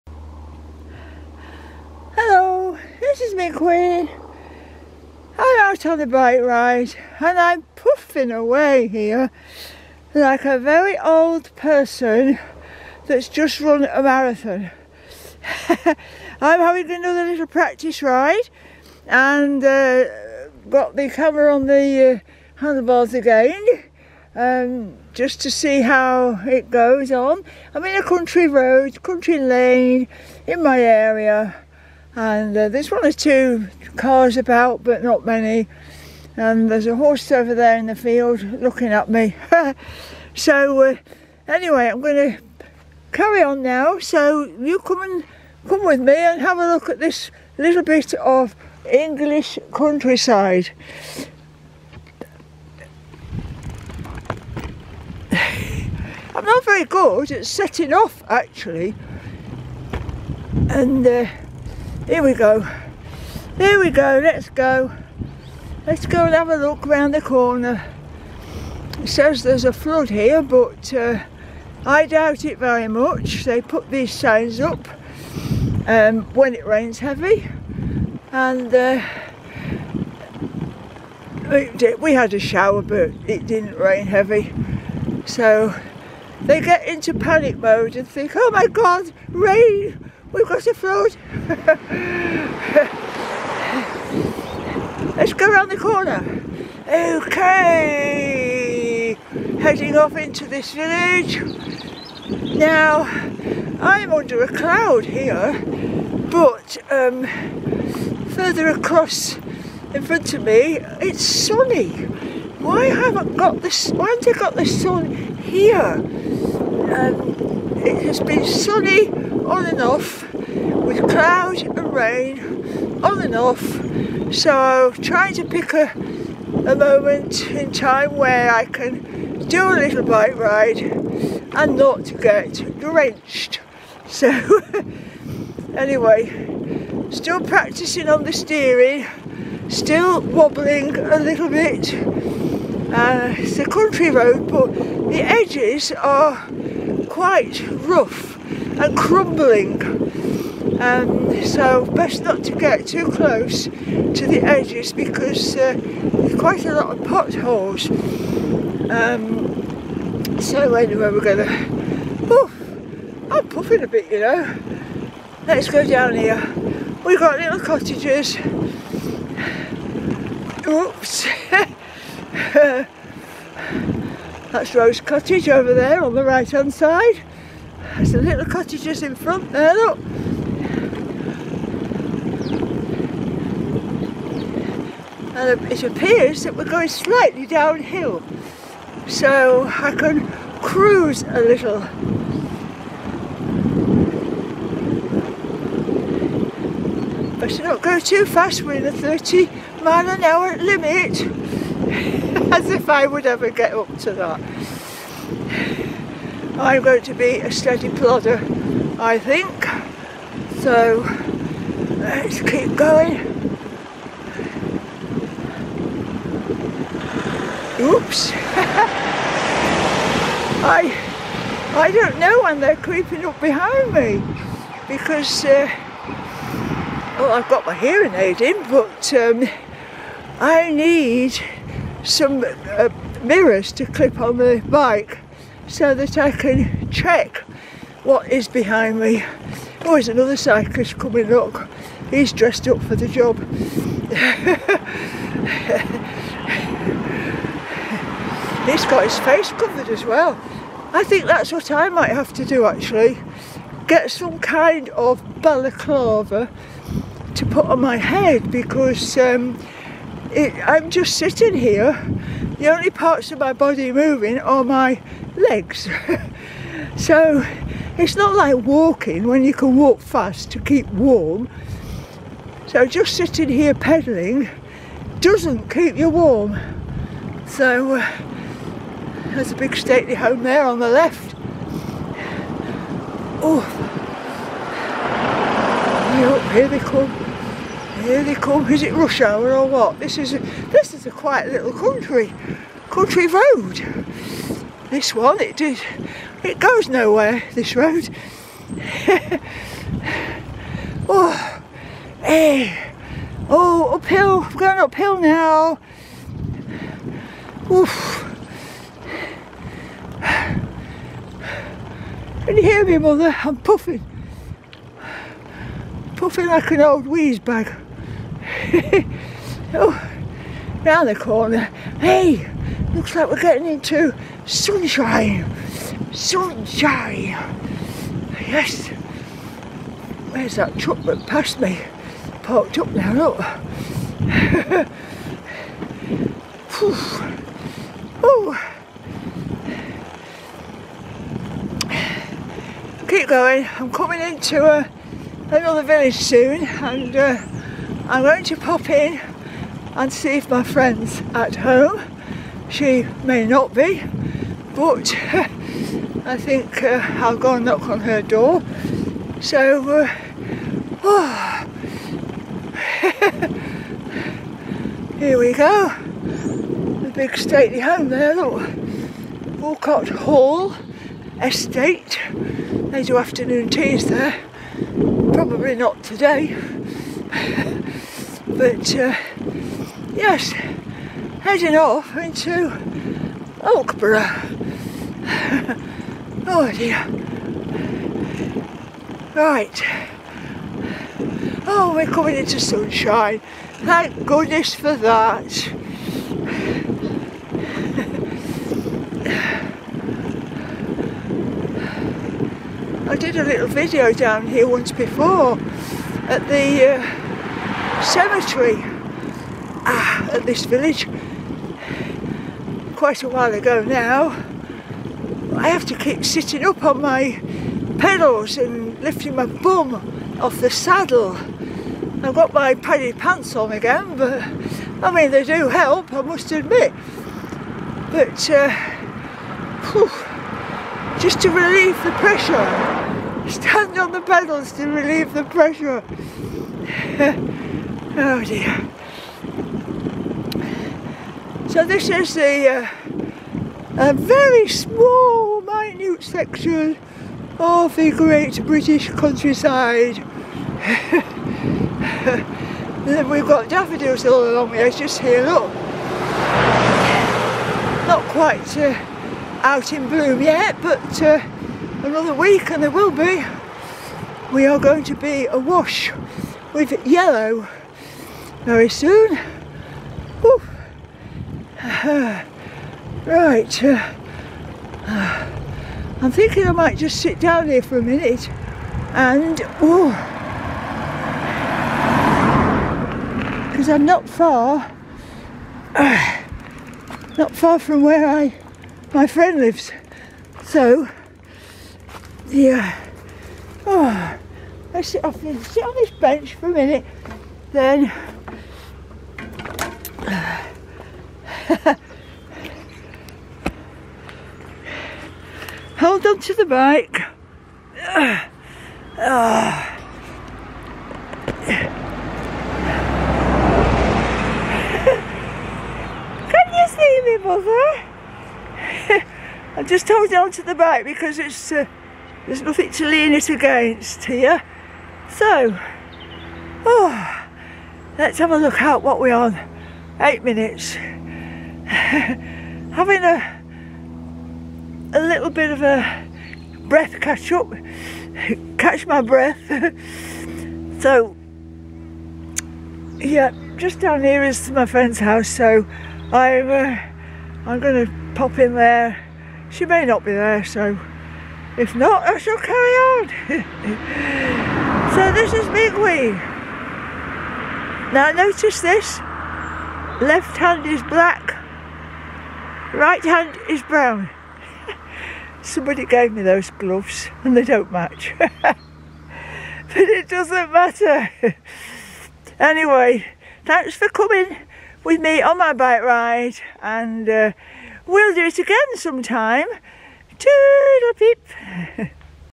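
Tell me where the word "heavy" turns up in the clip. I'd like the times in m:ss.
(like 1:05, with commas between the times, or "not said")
1:16, 1:24.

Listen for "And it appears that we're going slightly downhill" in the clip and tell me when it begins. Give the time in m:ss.
3:05.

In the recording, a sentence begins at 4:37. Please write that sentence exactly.
So uh, there's a big stately home there on the left.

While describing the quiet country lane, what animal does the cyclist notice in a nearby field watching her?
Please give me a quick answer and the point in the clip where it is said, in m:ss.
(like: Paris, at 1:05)
horse, at 0:36.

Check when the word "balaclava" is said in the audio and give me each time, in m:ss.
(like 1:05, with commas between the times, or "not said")
4:15.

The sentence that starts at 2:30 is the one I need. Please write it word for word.
Um, so best not to get too close to the edges because uh, there's quite a lot of potholes.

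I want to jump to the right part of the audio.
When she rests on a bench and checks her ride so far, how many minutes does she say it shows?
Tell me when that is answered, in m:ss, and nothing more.
8:50.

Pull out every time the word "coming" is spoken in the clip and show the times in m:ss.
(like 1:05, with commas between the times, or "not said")
4:00, 5:43, 6:32, 9:34.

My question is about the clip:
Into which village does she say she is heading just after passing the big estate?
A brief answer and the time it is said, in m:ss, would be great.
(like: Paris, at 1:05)
Oakborough, at 6:23.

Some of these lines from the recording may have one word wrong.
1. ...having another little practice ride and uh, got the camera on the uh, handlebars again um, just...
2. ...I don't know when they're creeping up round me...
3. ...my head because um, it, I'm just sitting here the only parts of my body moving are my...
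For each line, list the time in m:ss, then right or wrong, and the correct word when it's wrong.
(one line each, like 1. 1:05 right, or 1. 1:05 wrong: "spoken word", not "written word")
1. 0:16 right
2. 3:41 wrong: "behind", not "round"
3. 4:17 right.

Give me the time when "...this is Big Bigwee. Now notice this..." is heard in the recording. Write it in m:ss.
9:15.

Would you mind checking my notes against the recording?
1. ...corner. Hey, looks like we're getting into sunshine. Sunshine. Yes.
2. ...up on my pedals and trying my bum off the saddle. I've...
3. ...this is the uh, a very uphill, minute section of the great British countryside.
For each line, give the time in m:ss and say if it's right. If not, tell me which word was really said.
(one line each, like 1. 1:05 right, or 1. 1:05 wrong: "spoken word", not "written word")
1. 5:21 right
2. 6:56 wrong: "lifting", not "trying"
3. 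7:21 wrong: "small", not "uphill".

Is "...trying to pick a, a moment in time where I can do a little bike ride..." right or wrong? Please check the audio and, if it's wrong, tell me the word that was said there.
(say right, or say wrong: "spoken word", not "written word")
right.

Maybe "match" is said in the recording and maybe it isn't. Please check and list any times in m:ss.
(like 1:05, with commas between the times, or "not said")
9:27.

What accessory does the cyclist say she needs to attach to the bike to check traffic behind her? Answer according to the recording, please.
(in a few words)
mirrors.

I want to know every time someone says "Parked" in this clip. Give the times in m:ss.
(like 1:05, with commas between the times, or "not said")
5:32.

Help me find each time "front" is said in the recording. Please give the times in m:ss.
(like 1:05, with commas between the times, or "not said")
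1:50, 2:59.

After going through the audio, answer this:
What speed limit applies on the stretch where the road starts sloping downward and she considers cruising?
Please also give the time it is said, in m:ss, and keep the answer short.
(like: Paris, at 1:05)
30 mph, at 3:18.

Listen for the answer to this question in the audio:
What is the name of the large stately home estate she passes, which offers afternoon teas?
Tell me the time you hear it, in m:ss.
6:09.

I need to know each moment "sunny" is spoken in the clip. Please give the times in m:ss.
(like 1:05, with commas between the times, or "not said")
1:51, 1:58.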